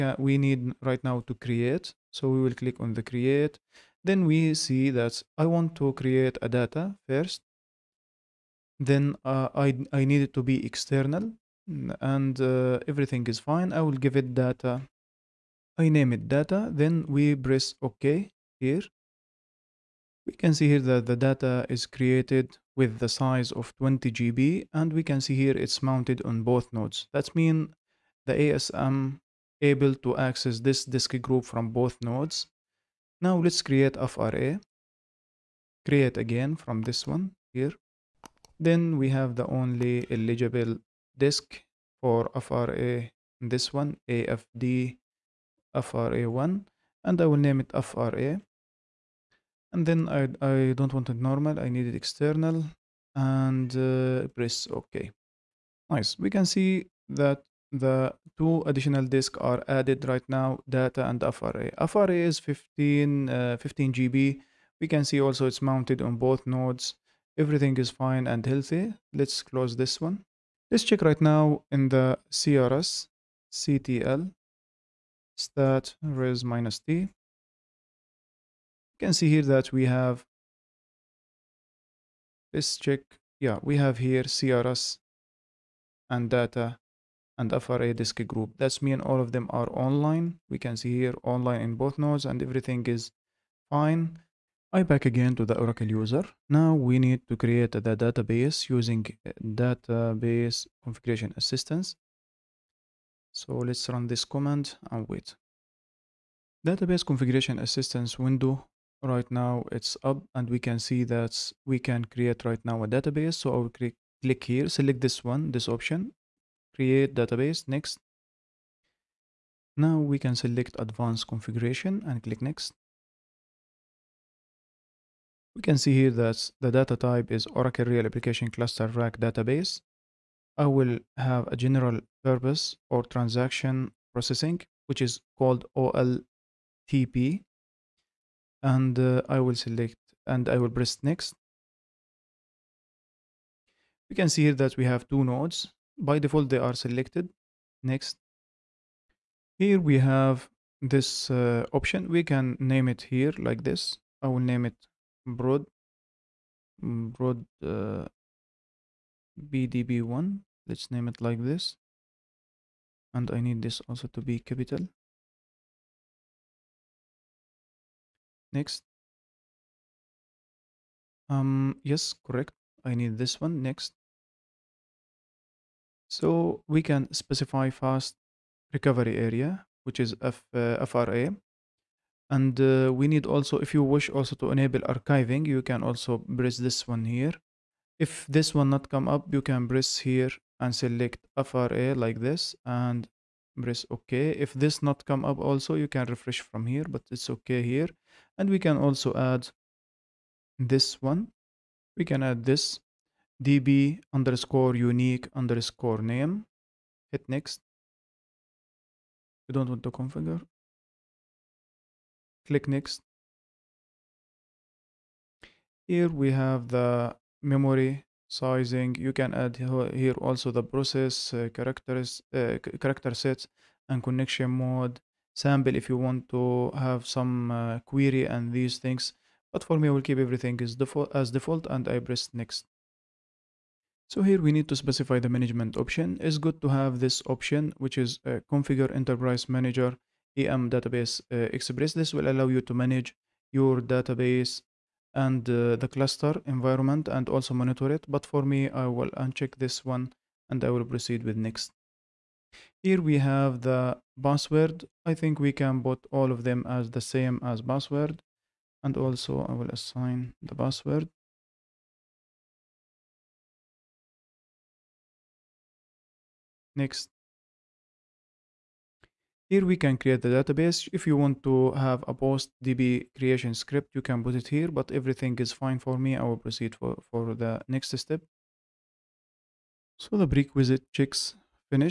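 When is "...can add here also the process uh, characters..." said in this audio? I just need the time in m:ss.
3:39.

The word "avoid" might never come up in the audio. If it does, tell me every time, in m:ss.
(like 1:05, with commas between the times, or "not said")
not said.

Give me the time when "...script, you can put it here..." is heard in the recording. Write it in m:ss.
4:33.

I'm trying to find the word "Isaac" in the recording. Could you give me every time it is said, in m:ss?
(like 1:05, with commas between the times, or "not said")
not said.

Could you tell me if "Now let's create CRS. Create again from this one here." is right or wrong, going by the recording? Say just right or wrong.
wrong.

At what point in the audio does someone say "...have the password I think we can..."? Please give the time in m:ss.
4:13.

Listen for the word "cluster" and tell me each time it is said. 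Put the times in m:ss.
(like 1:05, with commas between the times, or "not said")
2:08, 4:05.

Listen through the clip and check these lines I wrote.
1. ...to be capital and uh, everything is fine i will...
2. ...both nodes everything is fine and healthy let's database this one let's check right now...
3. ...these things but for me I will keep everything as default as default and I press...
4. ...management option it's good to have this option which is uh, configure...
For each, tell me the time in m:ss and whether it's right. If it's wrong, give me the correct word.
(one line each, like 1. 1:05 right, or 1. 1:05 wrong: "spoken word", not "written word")
1. 0:10 wrong: "external", not "capital"
2. 1:06 wrong: "close", not "database"
3. 3:48 right
4. 3:55 right.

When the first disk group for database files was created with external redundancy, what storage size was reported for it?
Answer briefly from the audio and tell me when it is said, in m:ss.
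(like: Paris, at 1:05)
20 GB, at 0:23.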